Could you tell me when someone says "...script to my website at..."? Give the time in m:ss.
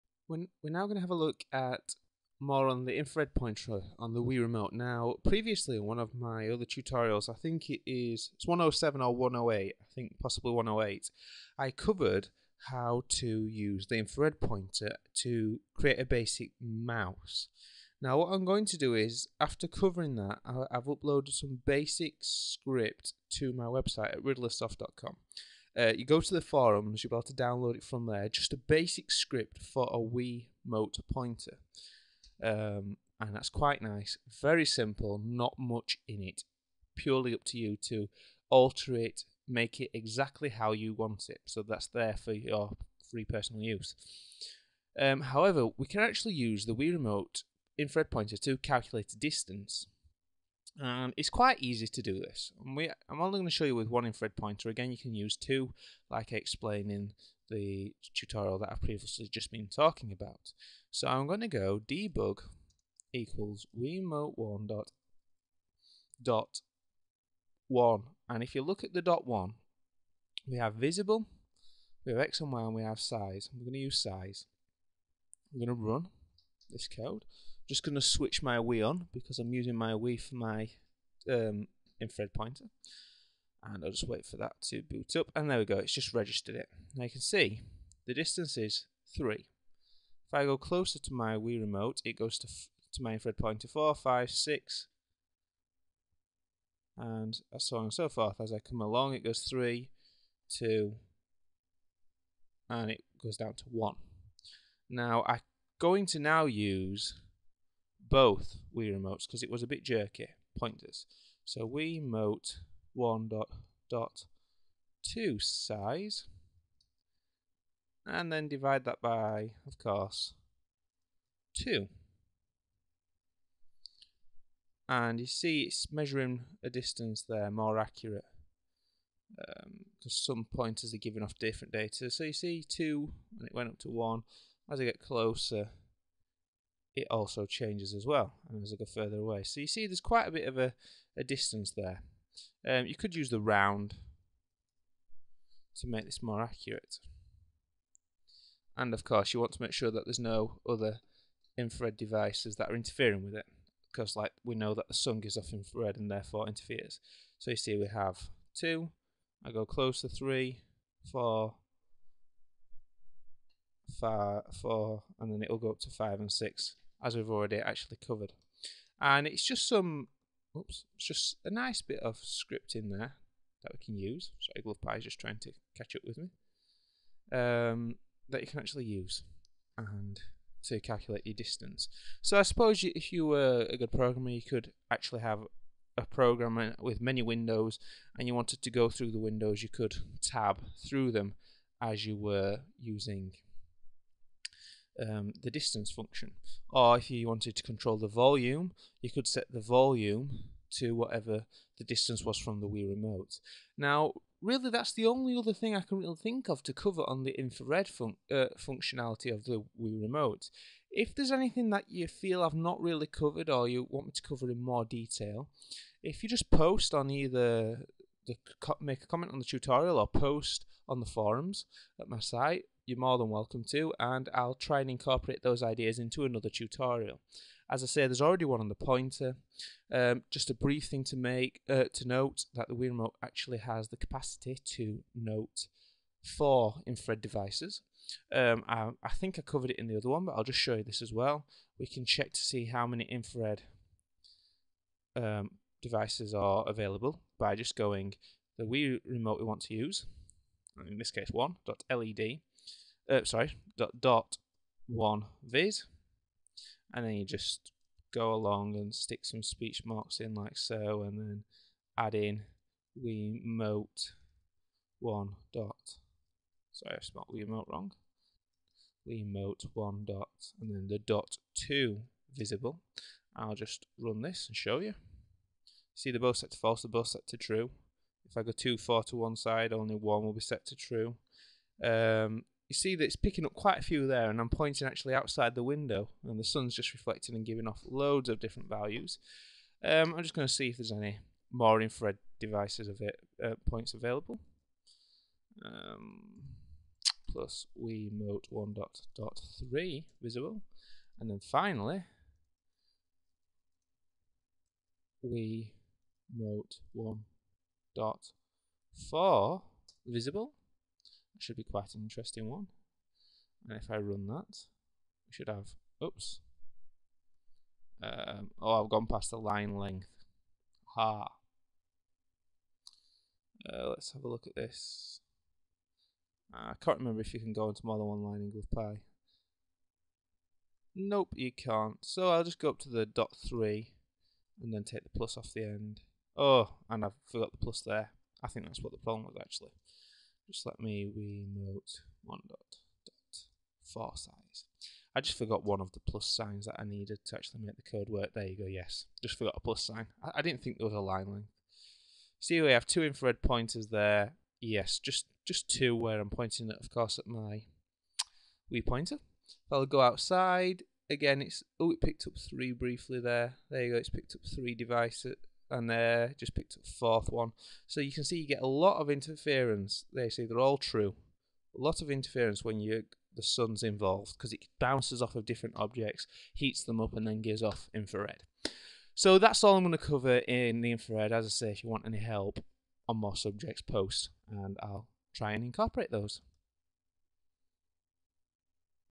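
0:22.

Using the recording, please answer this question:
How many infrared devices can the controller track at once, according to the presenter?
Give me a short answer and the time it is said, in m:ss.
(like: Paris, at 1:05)
4, at 3:56.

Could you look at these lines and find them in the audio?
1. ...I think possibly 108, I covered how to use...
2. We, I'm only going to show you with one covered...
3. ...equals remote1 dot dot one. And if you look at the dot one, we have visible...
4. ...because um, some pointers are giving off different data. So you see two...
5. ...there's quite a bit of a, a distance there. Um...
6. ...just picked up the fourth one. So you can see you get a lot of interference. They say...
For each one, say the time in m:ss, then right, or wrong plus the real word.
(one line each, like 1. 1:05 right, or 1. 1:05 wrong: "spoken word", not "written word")
1. 0:09 right
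2. 0:52 wrong: "infrared", not "covered"
3. 1:03 right
4. 2:09 right
5. 2:19 right
6. 6:06 right.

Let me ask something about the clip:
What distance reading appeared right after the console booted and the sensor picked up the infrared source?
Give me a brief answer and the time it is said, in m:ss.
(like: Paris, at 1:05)
3, at 1:28.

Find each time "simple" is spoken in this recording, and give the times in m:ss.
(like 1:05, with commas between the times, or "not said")
0:34.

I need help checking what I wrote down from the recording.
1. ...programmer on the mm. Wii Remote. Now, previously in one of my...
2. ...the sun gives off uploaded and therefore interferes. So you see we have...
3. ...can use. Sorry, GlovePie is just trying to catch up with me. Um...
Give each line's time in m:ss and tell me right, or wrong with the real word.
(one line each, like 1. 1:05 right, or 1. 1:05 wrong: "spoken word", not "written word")
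1. 0:03 wrong: "pointer", not "programmer"
2. 2:34 wrong: "infrared", not "uploaded"
3. 2:53 right.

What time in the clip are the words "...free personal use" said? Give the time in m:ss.
0:43.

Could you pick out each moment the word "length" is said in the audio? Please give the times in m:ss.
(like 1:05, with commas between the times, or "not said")
5:19, 5:51.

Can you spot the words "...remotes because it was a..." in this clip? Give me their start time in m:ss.
1:48.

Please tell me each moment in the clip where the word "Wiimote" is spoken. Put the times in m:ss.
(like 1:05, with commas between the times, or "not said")
4:23, 4:29, 4:57, 5:05.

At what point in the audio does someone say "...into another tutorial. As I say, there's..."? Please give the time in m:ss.
3:45.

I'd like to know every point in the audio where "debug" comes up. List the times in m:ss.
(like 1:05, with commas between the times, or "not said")
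1:01.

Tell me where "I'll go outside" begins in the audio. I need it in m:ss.
5:59.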